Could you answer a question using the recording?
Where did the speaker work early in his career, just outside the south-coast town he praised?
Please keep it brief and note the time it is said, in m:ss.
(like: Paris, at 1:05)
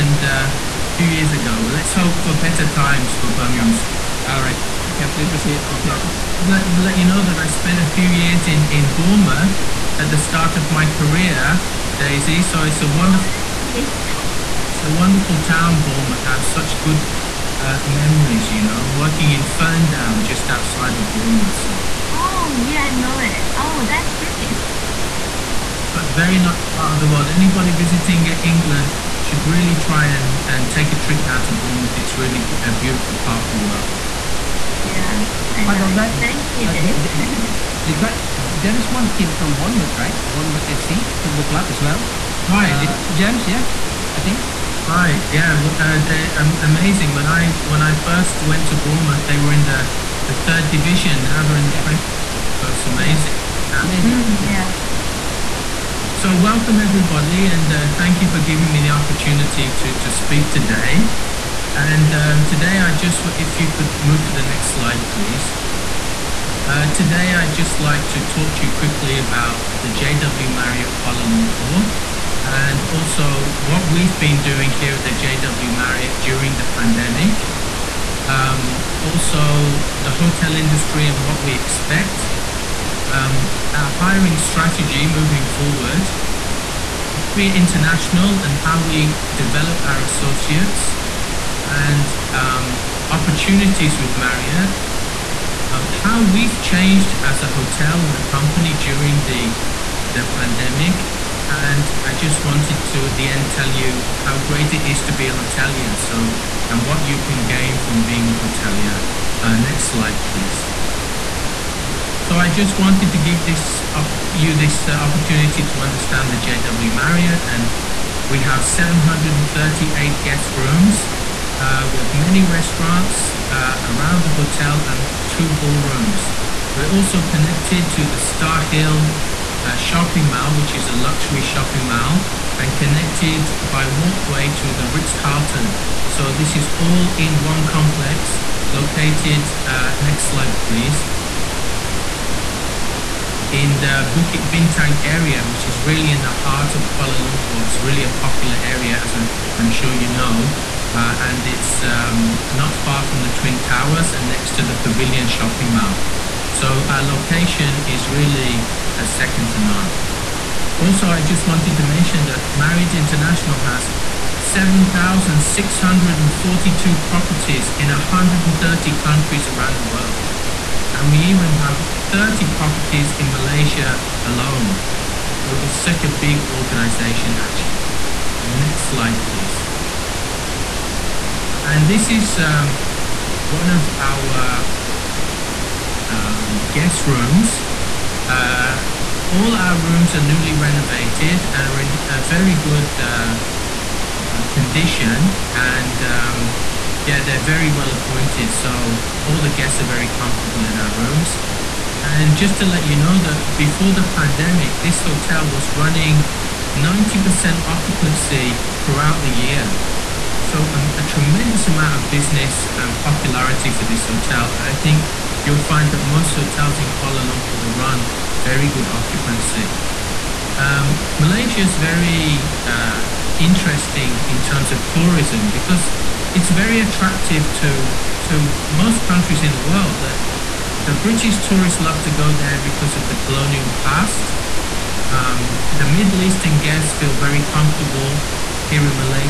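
Ferndown, at 0:19.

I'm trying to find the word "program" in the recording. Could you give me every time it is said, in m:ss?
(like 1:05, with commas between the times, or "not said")
not said.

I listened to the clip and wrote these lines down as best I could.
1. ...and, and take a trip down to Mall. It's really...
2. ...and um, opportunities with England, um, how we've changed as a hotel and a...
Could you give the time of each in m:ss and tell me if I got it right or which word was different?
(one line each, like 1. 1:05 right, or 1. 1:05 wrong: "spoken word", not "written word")
1. 0:30 wrong: "Bournemouth", not "Mall"
2. 1:31 wrong: "Marriott", not "England".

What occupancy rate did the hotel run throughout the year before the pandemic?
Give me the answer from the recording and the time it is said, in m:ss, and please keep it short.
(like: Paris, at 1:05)
90%, at 3:26.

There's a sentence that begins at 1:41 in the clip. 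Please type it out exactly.
And I just wanted to, at the end, tell you how great it is to be a hotelier.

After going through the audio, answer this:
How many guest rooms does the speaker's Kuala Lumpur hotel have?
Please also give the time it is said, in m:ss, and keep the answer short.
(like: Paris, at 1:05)
738, at 1:58.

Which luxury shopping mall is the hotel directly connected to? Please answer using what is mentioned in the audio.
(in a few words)
Starhill.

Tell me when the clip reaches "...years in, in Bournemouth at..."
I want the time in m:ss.
0:08.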